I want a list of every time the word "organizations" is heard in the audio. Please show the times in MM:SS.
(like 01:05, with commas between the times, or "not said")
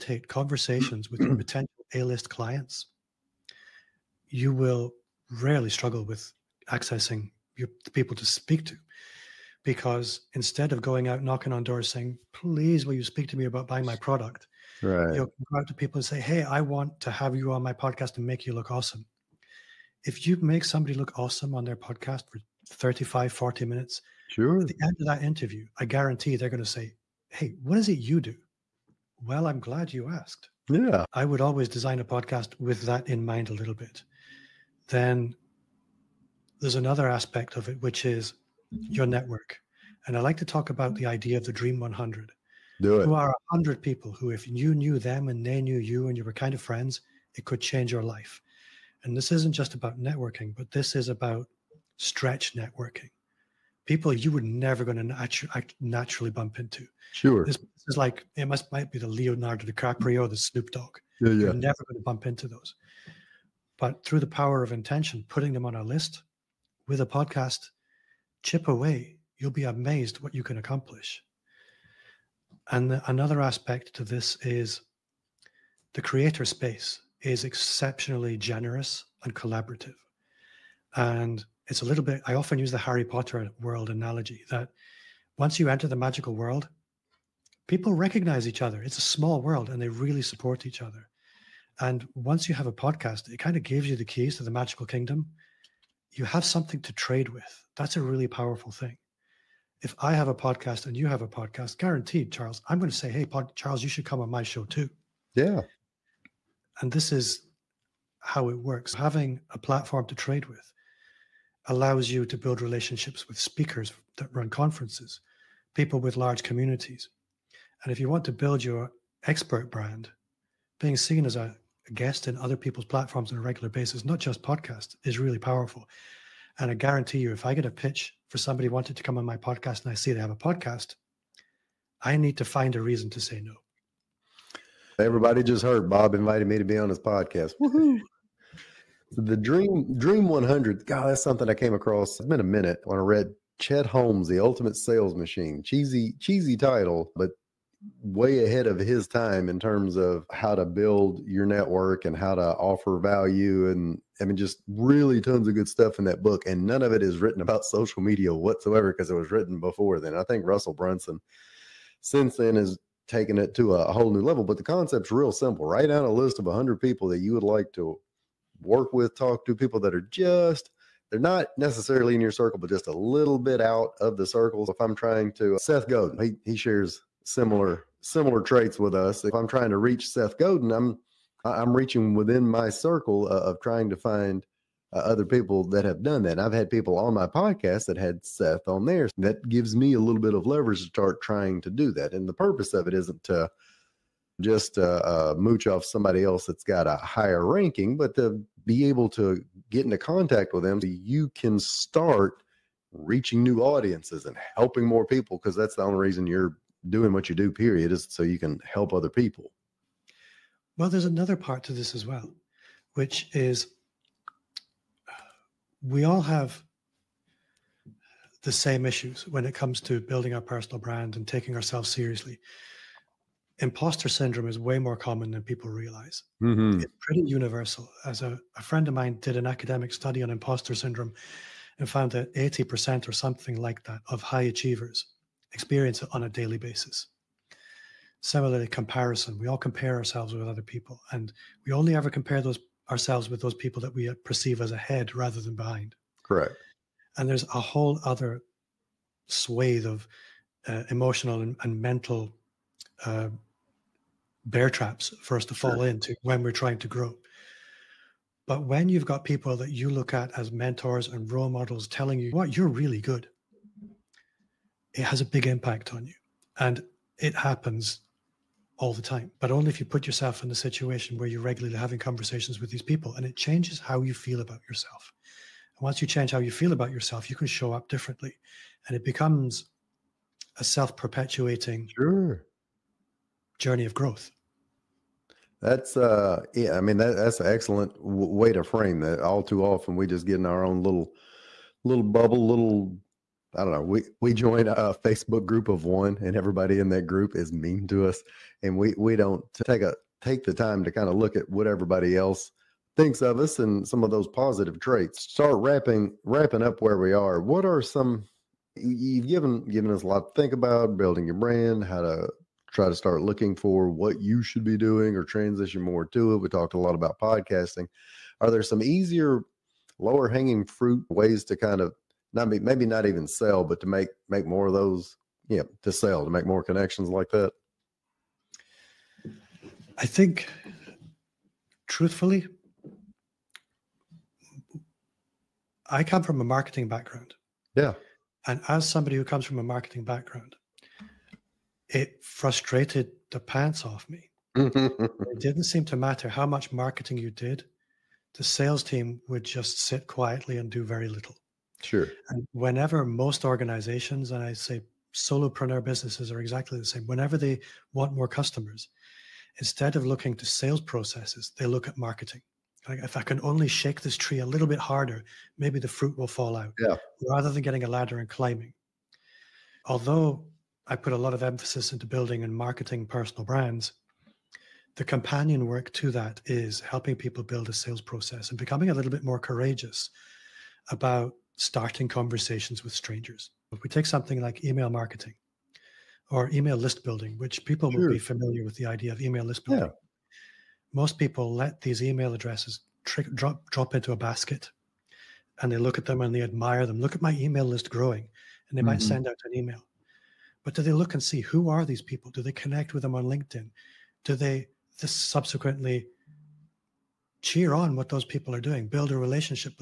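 05:53.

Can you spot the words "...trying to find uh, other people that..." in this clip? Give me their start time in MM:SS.
03:03.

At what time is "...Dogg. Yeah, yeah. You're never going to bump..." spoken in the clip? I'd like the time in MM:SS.
01:00.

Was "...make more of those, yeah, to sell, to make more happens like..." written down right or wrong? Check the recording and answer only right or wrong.
wrong.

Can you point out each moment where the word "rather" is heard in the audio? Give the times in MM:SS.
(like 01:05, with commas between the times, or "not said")
04:05, 06:07.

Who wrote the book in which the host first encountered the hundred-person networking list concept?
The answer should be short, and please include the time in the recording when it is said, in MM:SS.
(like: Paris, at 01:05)
Chet Holmes, at 02:23.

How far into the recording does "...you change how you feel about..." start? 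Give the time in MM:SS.
04:36.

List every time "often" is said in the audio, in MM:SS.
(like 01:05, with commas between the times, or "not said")
01:22, 04:49.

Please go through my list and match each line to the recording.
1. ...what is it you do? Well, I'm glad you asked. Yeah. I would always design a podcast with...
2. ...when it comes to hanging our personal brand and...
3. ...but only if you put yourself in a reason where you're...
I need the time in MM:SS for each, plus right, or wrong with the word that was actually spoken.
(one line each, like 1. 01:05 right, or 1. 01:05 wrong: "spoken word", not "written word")
1. 00:27 right
2. 03:39 wrong: "building", not "hanging"
3. 04:29 wrong: "situation", not "reason".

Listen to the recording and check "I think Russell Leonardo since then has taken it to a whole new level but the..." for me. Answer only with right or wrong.
wrong.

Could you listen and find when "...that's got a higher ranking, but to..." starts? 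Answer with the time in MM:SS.
03:16.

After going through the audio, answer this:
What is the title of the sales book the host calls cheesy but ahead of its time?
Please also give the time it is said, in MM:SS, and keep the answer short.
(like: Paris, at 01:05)
The Ultimate Sales Machine, at 02:24.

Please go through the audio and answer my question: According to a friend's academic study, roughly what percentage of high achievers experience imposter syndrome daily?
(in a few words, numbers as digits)
80%.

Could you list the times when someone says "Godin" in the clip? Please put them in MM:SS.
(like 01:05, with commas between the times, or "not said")
02:55, 03:00.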